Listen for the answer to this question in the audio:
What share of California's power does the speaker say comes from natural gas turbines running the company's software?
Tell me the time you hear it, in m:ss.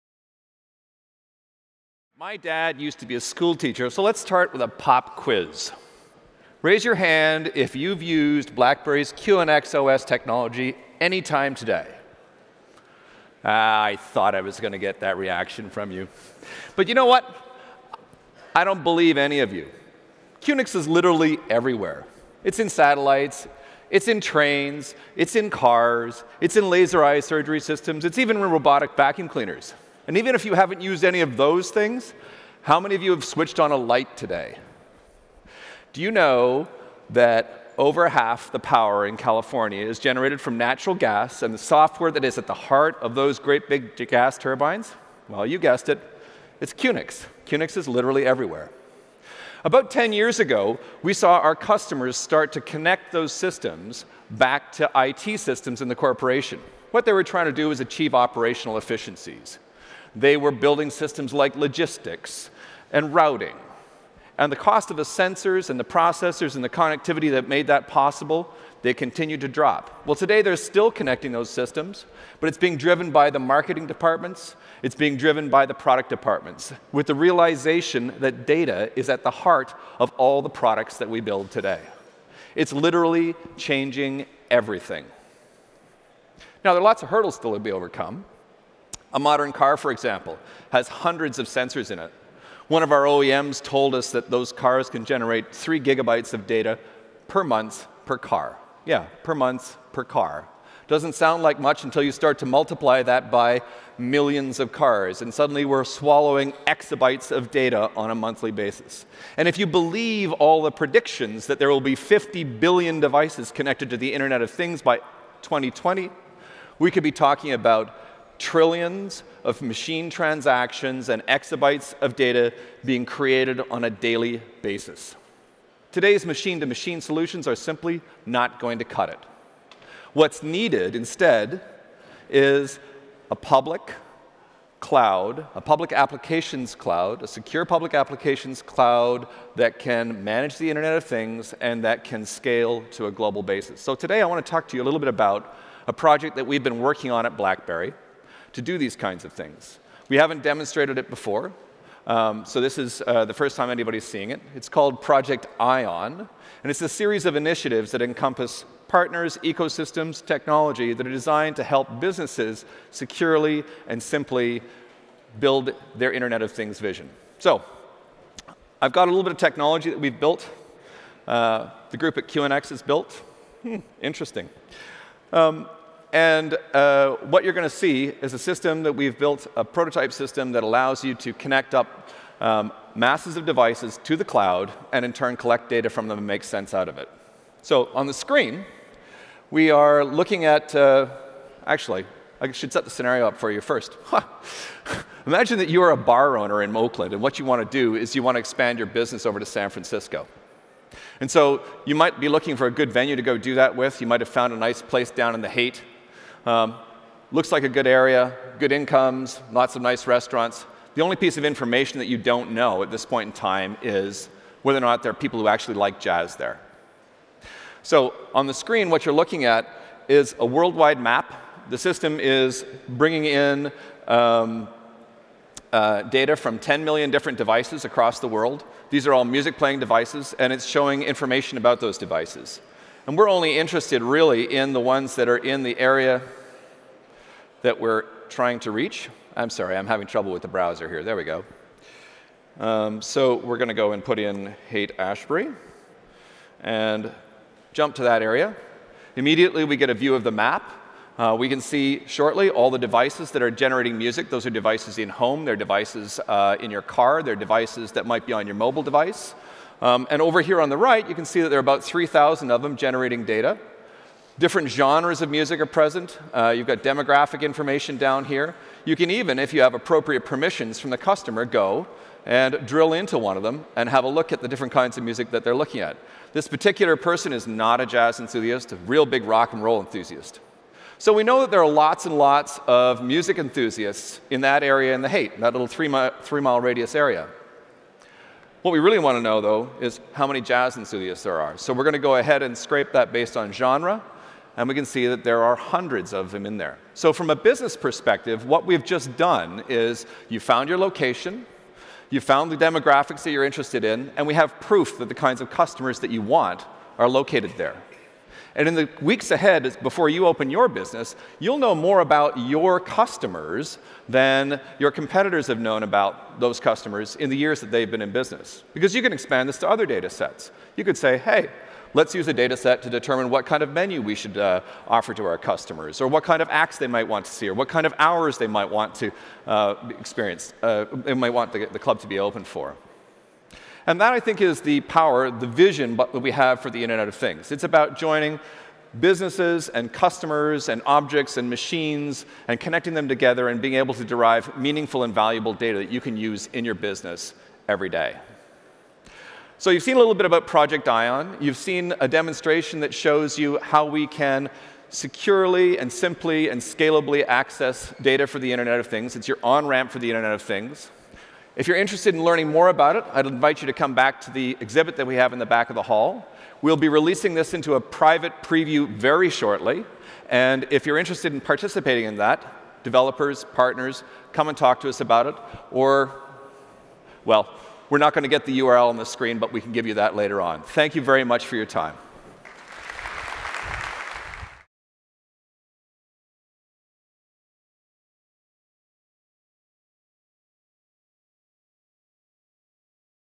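0:37.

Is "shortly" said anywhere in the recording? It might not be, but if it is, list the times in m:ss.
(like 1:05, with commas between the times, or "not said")
4:12, 6:09.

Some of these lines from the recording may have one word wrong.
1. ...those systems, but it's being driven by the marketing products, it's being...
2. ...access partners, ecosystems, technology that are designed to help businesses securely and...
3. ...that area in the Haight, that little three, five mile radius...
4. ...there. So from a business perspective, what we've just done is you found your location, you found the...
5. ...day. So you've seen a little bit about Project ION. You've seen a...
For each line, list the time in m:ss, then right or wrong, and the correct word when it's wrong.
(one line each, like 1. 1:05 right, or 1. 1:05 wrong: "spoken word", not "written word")
1. 1:11 wrong: "departments", not "products"
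2. 2:38 wrong: "encompass", not "access"
3. 4:44 wrong: "three", not "five"
4. 4:56 right
5. 5:47 right.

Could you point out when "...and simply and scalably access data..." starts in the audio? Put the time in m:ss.
5:55.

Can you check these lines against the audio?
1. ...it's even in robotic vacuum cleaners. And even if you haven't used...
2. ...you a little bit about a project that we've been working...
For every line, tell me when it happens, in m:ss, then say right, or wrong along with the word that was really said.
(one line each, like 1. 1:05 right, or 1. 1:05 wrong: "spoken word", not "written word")
1. 0:28 right
2. 2:24 right.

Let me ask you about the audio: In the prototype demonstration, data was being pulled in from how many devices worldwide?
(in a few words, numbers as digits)
10 million.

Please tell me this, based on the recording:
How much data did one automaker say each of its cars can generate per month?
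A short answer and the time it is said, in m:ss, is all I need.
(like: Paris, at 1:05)
3 gigabytes, at 1:35.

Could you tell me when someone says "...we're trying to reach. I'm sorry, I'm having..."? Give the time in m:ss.
3:57.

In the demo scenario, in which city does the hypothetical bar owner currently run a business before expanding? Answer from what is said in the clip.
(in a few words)
Oakland.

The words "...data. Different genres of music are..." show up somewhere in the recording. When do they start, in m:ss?
4:23.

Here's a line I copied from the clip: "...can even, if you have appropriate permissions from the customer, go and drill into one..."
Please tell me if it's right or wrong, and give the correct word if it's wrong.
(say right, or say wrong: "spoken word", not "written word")
right.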